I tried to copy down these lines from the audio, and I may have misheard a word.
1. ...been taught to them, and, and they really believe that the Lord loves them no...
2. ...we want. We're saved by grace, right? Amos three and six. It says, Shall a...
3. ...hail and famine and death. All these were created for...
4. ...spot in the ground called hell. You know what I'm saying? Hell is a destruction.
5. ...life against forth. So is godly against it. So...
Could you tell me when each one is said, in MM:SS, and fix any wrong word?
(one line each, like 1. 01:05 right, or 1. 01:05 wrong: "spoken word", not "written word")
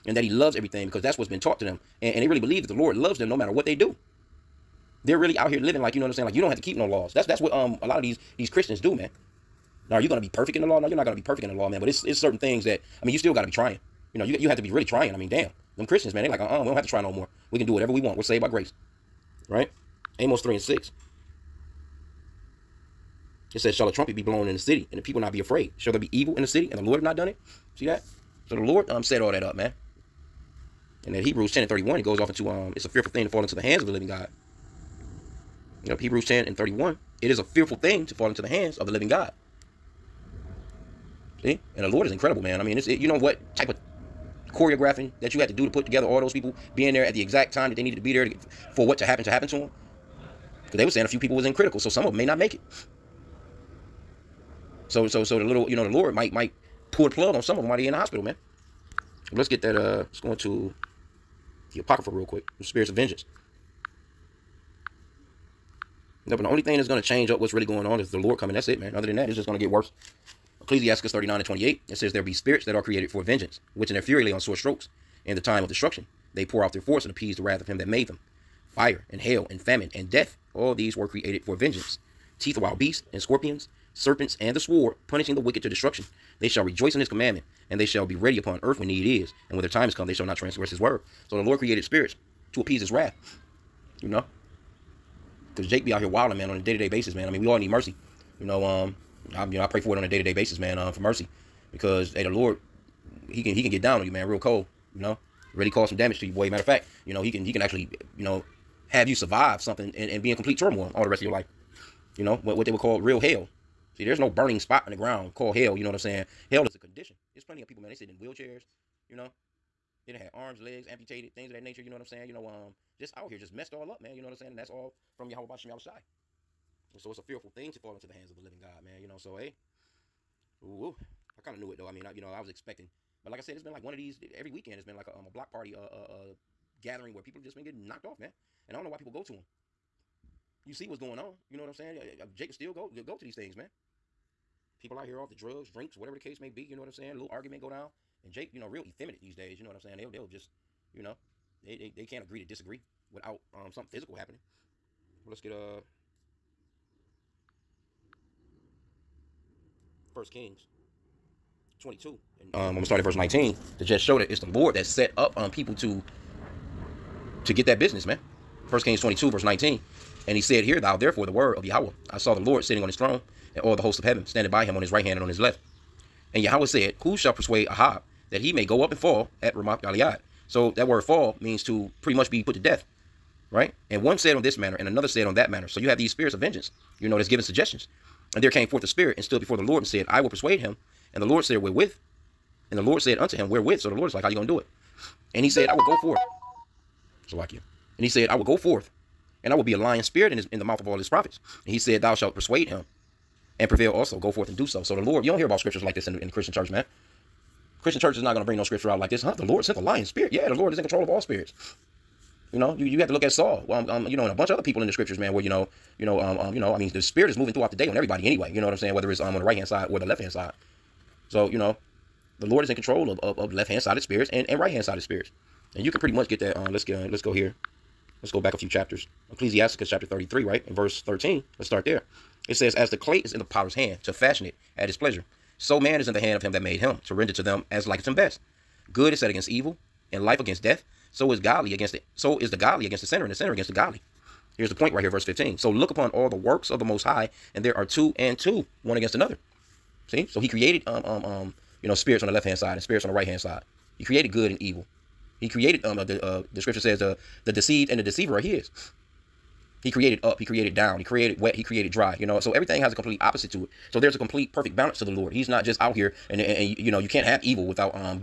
1. 00:01 right
2. 00:17 right
3. 01:19 right
4. 01:54 wrong: "condition", not "destruction"
5. 04:00 wrong: "death", not "forth".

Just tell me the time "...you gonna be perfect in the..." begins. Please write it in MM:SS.
00:09.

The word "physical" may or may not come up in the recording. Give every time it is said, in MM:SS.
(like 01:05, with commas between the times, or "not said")
02:33.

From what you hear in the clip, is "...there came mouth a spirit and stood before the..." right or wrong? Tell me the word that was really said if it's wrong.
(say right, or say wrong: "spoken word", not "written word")
wrong: "forth", not "mouth".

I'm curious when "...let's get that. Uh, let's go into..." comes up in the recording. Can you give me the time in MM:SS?
00:59.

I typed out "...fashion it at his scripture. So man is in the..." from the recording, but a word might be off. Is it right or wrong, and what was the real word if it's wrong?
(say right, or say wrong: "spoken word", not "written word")
wrong: "pleasure", not "scripture".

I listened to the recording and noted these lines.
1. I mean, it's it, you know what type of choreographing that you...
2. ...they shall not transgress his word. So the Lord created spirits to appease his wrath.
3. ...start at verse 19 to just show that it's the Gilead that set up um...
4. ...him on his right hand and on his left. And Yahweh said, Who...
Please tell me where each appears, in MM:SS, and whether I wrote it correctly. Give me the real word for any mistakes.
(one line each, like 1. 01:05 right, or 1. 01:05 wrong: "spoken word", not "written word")
1. 00:42 right
2. 01:30 right
3. 02:42 wrong: "Lord", not "Gilead"
4. 02:54 right.